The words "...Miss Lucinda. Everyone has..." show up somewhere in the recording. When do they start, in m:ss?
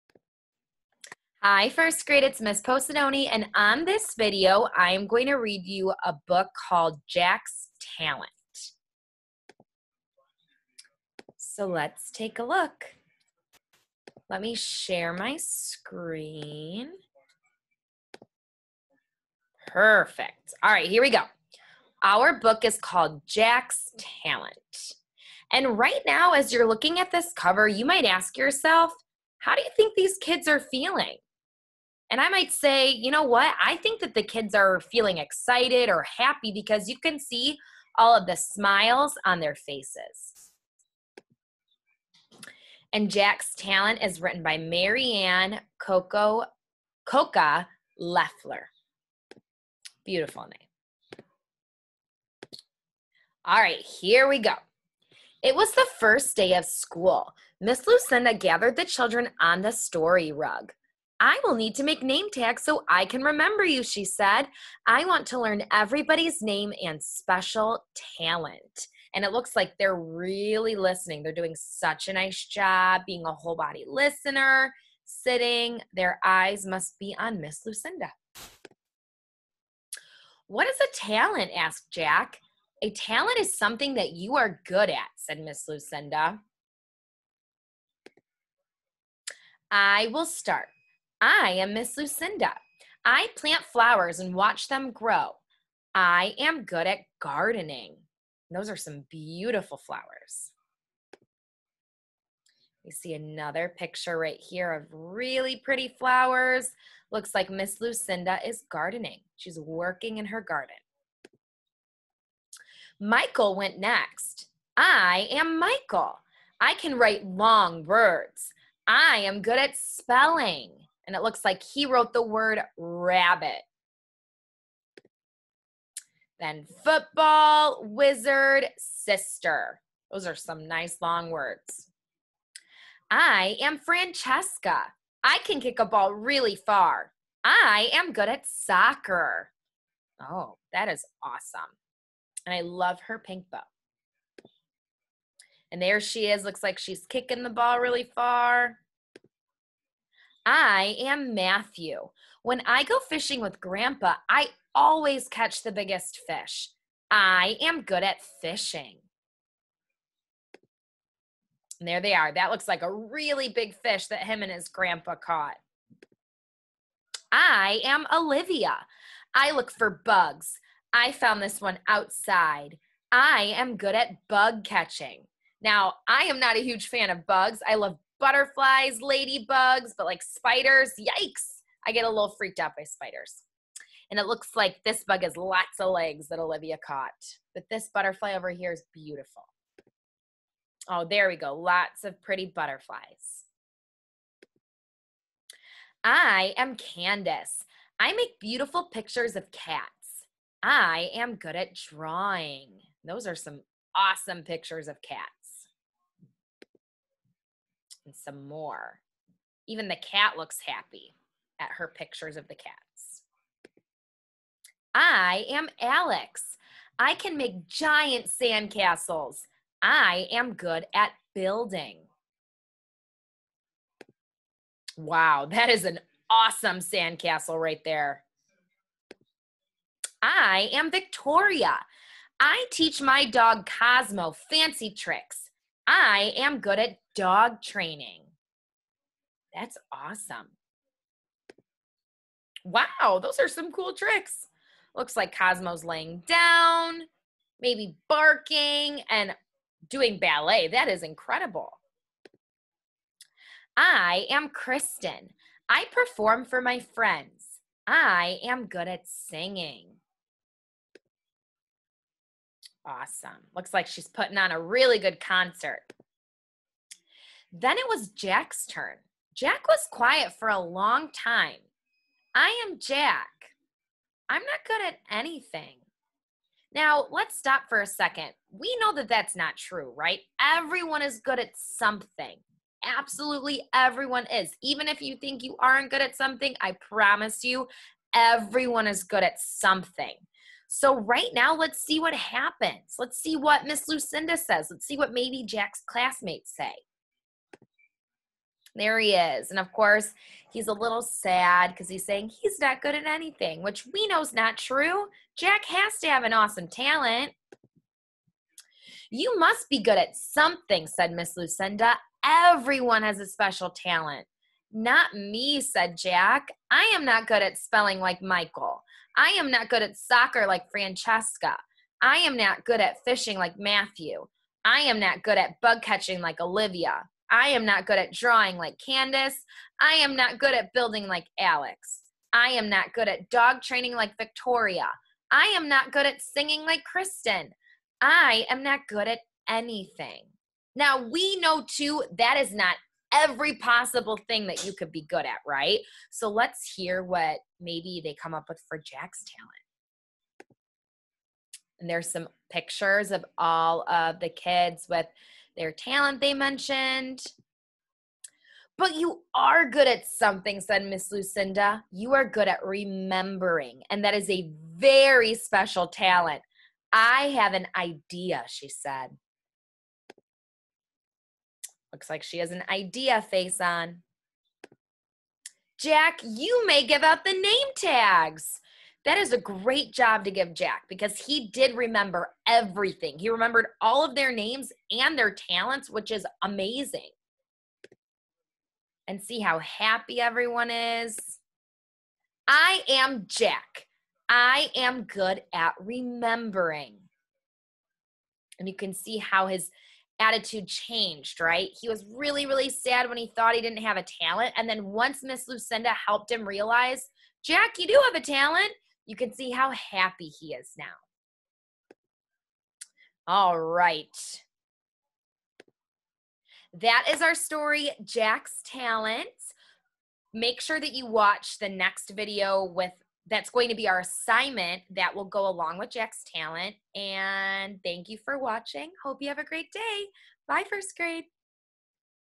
5:11.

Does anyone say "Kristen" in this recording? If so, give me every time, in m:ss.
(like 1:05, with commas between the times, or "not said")
4:14, 5:36.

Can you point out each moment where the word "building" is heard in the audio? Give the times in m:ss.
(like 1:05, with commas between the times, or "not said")
3:41, 5:30.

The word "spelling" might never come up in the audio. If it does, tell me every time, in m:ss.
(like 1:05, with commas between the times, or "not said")
1:59, 5:17.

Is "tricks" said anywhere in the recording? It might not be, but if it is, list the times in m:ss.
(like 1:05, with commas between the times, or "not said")
3:54, 4:03.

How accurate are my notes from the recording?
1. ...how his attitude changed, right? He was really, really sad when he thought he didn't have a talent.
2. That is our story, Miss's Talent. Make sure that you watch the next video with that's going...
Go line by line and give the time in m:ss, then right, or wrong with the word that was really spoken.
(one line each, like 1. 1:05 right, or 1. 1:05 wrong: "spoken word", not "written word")
1. 6:39 right
2. 6:56 wrong: "Jack", not "Miss".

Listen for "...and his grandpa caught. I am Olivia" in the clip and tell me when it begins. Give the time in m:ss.
2:44.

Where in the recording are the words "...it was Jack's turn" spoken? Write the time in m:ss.
4:27.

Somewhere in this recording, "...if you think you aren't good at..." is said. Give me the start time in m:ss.
4:44.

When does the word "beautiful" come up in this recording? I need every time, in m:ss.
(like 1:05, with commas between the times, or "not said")
0:50, 1:39, 3:08, 3:18.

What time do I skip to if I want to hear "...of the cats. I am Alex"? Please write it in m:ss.
3:32.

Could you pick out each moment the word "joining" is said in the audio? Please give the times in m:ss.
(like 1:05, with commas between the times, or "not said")
not said.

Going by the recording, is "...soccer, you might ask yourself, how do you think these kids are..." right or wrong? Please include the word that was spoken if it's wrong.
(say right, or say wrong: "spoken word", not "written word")
wrong: "cover", not "soccer".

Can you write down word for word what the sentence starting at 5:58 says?
But you are good at something, said Miss Lucinda.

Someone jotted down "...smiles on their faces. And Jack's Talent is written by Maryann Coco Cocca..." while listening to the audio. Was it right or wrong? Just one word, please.
right.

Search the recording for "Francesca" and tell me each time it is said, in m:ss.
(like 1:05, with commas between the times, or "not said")
2:13, 5:20.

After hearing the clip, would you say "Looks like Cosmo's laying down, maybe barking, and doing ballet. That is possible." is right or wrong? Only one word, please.
wrong.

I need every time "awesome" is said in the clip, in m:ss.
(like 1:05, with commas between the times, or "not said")
2:21, 3:23, 3:46, 3:59, 4:22, 5:06.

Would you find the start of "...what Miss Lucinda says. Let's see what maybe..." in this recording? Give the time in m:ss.
4:53.